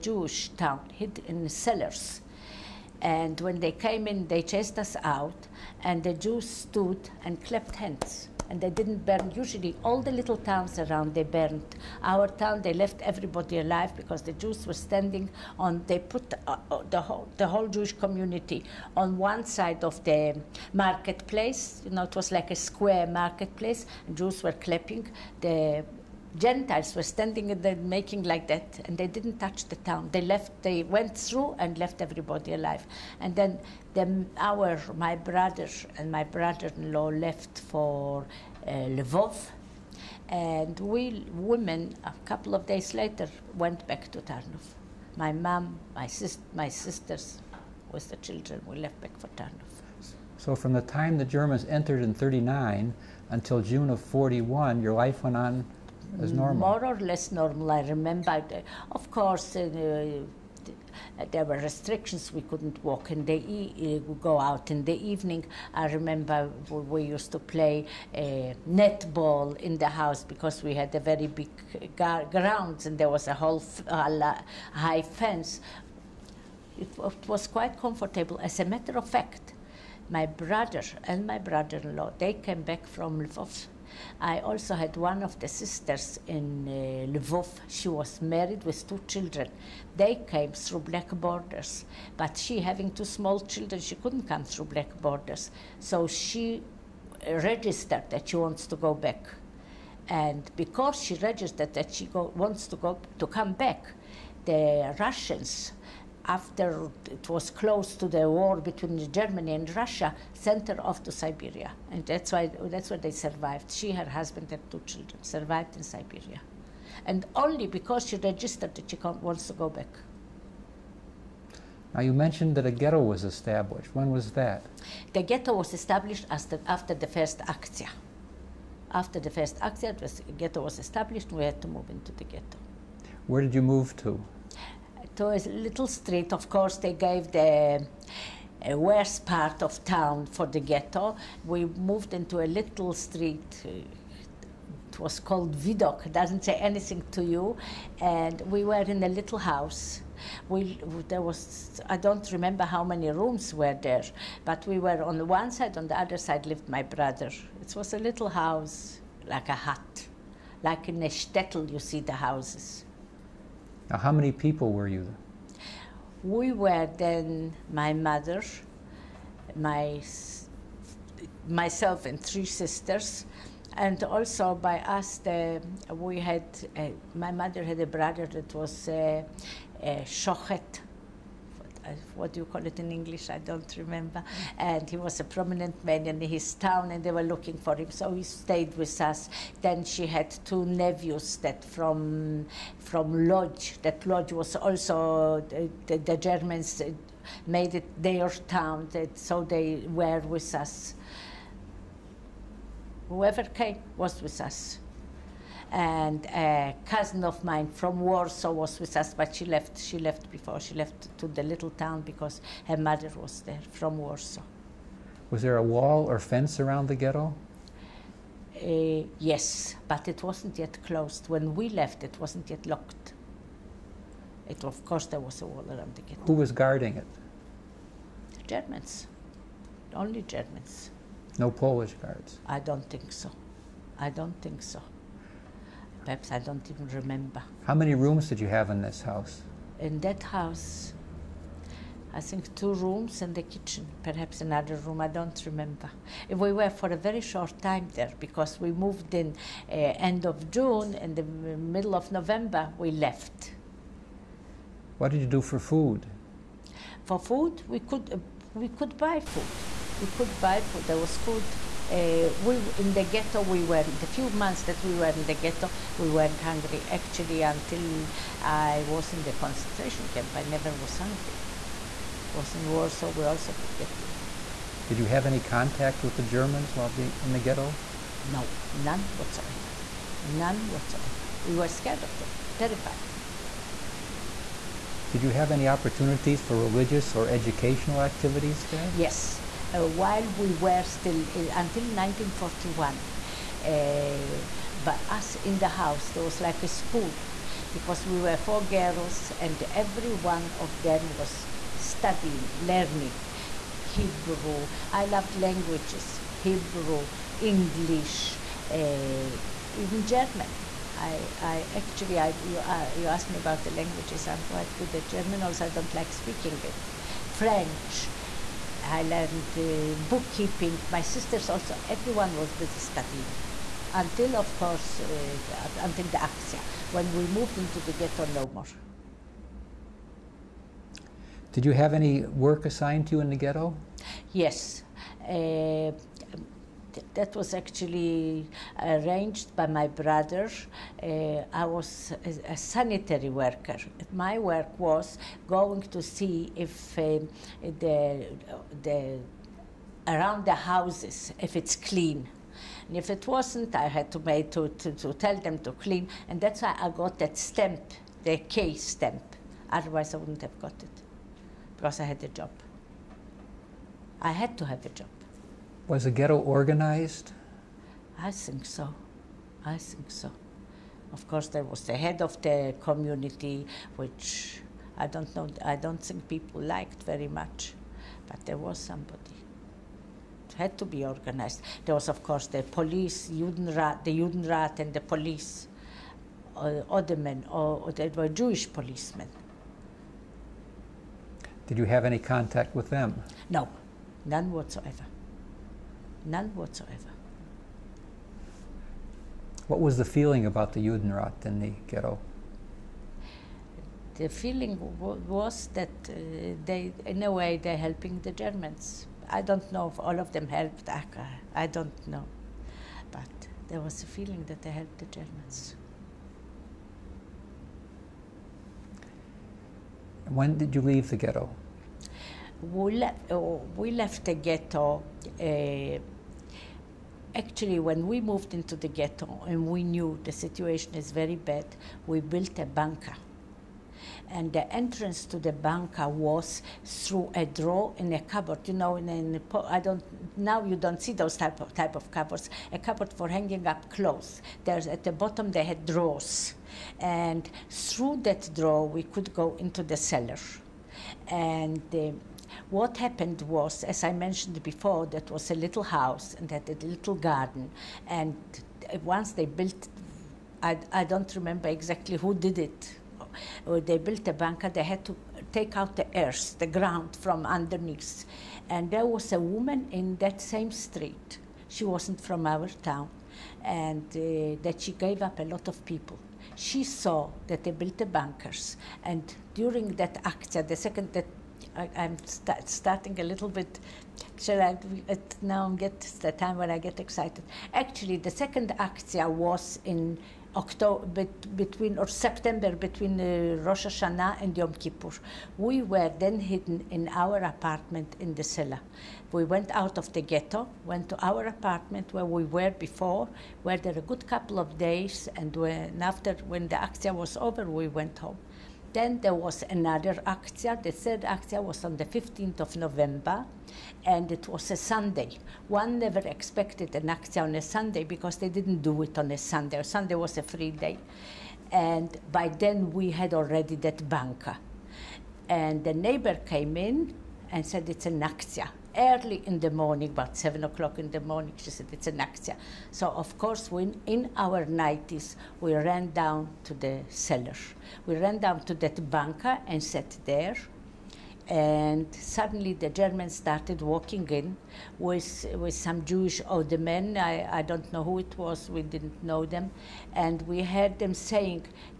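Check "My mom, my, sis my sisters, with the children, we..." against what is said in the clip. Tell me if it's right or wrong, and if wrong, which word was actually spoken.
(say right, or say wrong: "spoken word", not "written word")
right.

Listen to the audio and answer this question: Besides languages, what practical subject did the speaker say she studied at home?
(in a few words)
Bookkeeping.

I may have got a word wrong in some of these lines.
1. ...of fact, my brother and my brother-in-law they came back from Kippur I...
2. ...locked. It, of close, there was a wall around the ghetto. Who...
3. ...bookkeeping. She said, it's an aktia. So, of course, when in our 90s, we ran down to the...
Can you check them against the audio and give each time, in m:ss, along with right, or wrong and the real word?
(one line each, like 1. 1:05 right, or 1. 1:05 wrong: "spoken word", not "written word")
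1. 1:18 wrong: "Lvov", not "Kippur"
2. 3:42 wrong: "course", not "close"
3. 8:51 wrong: "morning", not "bookkeeping".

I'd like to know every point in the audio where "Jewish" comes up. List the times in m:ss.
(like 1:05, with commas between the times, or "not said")
0:17, 6:28, 9:06.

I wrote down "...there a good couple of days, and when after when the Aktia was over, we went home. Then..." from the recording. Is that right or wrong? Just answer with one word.
right.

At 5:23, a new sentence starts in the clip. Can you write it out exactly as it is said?
Until, of course, uh, until the Axia, when we moved into the ghetto no more.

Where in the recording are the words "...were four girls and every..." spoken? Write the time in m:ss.
4:58.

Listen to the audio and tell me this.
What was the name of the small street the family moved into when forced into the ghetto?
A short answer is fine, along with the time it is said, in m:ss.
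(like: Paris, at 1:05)
Vidok, at 2:25.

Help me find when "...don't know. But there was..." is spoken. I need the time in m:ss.
6:51.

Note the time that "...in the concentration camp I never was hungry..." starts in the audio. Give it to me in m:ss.
4:29.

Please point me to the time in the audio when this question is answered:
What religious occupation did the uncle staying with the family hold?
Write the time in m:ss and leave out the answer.
3:00.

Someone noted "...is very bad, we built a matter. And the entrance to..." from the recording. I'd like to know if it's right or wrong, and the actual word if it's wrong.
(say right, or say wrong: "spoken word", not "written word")
wrong: "bunker", not "matter".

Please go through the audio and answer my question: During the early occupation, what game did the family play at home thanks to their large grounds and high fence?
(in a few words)
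Netball.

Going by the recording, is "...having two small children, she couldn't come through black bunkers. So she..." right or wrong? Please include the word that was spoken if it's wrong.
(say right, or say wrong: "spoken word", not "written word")
wrong: "borders", not "bunkers".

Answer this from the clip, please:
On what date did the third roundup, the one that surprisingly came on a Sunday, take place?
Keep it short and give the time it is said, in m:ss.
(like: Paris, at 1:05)
15 November, at 8:32.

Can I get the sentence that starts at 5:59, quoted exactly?
Otherwise, I wouldn't have got it because I had a job.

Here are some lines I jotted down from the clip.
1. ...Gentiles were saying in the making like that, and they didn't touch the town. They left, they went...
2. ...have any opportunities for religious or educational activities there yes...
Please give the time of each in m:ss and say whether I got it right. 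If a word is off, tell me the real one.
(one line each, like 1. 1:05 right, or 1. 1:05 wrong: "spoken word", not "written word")
1. 0:26 wrong: "standing", not "saying"
2. 4:45 right.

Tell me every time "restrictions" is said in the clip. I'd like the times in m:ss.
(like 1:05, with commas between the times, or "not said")
1:01.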